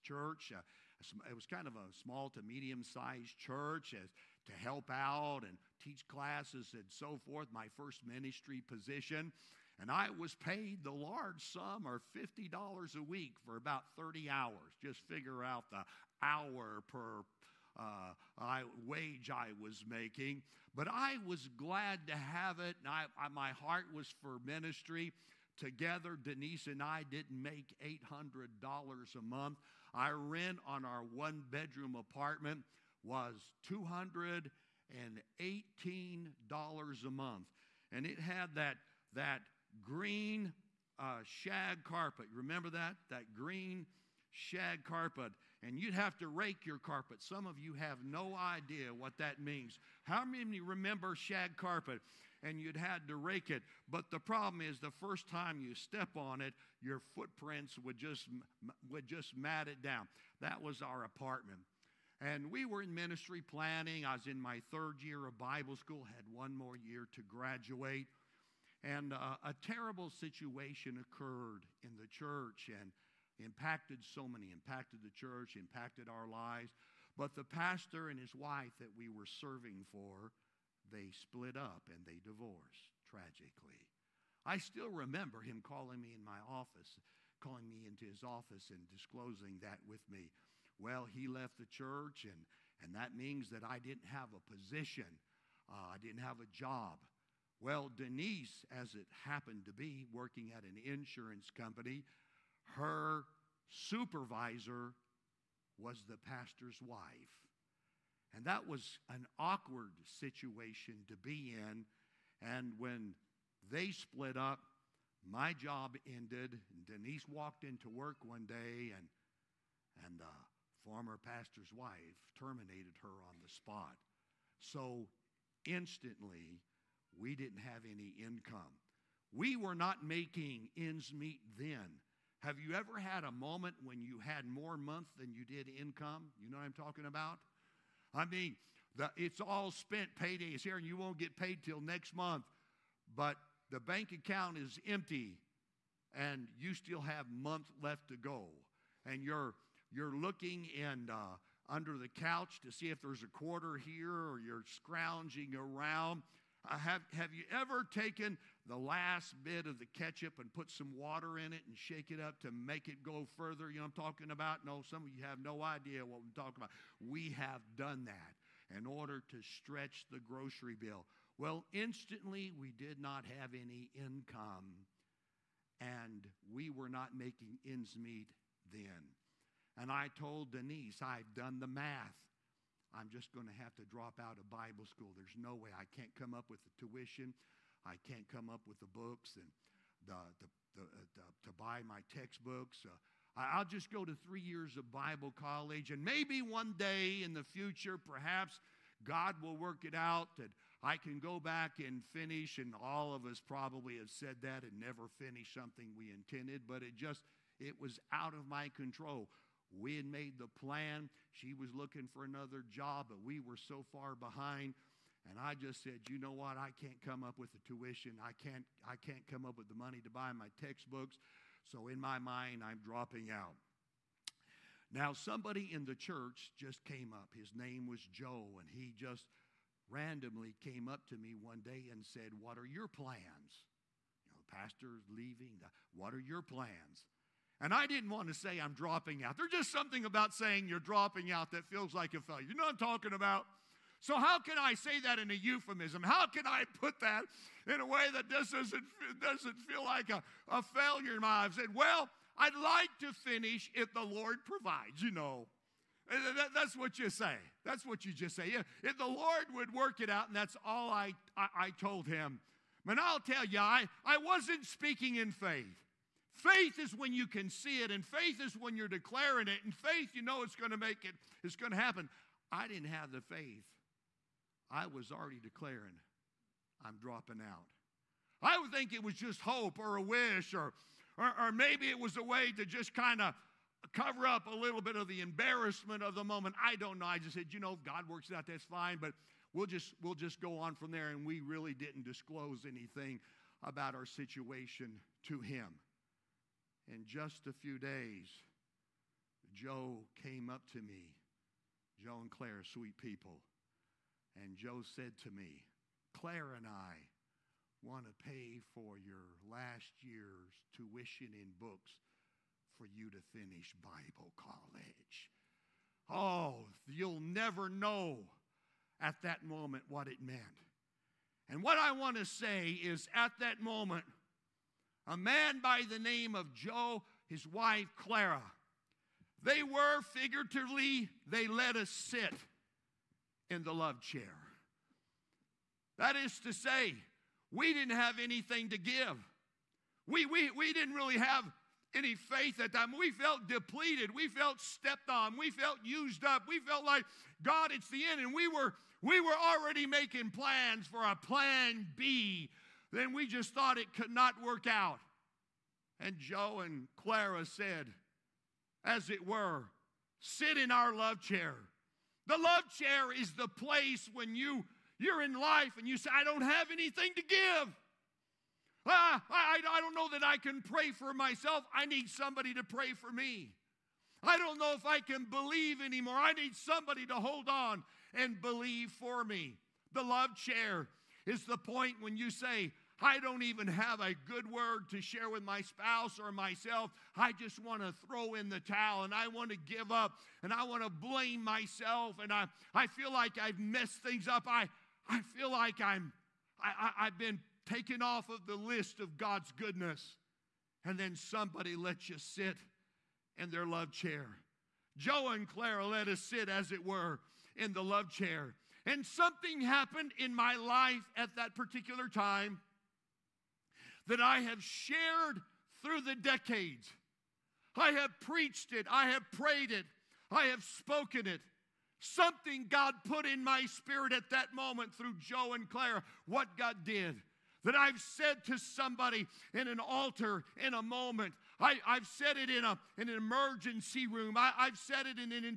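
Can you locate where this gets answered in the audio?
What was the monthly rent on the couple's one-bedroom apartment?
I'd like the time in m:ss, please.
0:33.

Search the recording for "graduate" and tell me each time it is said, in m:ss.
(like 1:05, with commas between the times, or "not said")
1:07.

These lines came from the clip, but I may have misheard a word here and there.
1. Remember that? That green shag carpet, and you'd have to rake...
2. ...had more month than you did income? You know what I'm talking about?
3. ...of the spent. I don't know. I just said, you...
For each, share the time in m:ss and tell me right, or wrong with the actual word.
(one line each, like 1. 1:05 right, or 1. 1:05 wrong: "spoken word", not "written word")
1. 0:42 right
2. 2:14 right
3. 4:46 wrong: "moment", not "spent".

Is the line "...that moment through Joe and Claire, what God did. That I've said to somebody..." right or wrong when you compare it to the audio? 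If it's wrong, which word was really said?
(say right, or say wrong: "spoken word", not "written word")
right.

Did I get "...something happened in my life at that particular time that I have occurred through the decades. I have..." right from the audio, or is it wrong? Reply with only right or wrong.
wrong.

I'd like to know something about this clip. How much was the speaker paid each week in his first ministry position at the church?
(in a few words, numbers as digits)
$50.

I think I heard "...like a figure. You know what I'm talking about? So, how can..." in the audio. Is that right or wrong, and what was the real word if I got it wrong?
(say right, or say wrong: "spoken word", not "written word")
wrong: "failure", not "figure".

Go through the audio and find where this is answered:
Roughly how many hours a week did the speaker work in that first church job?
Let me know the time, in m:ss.
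0:13.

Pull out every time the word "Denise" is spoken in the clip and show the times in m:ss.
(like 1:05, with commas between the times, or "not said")
0:26, 1:37, 1:56, 3:00.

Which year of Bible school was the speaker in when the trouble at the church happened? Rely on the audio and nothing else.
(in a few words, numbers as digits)
third year.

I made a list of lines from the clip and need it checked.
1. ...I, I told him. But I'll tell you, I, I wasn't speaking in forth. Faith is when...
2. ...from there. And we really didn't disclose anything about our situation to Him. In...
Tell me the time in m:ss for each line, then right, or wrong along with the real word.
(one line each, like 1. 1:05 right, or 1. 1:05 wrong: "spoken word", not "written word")
1. 4:21 wrong: "faith", not "forth"
2. 4:50 right.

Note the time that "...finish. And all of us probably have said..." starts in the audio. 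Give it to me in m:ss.
3:22.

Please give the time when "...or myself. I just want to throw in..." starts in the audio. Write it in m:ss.
6:26.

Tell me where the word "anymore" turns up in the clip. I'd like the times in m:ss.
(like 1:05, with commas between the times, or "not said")
6:15.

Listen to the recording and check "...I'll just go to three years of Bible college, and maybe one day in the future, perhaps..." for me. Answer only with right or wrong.
right.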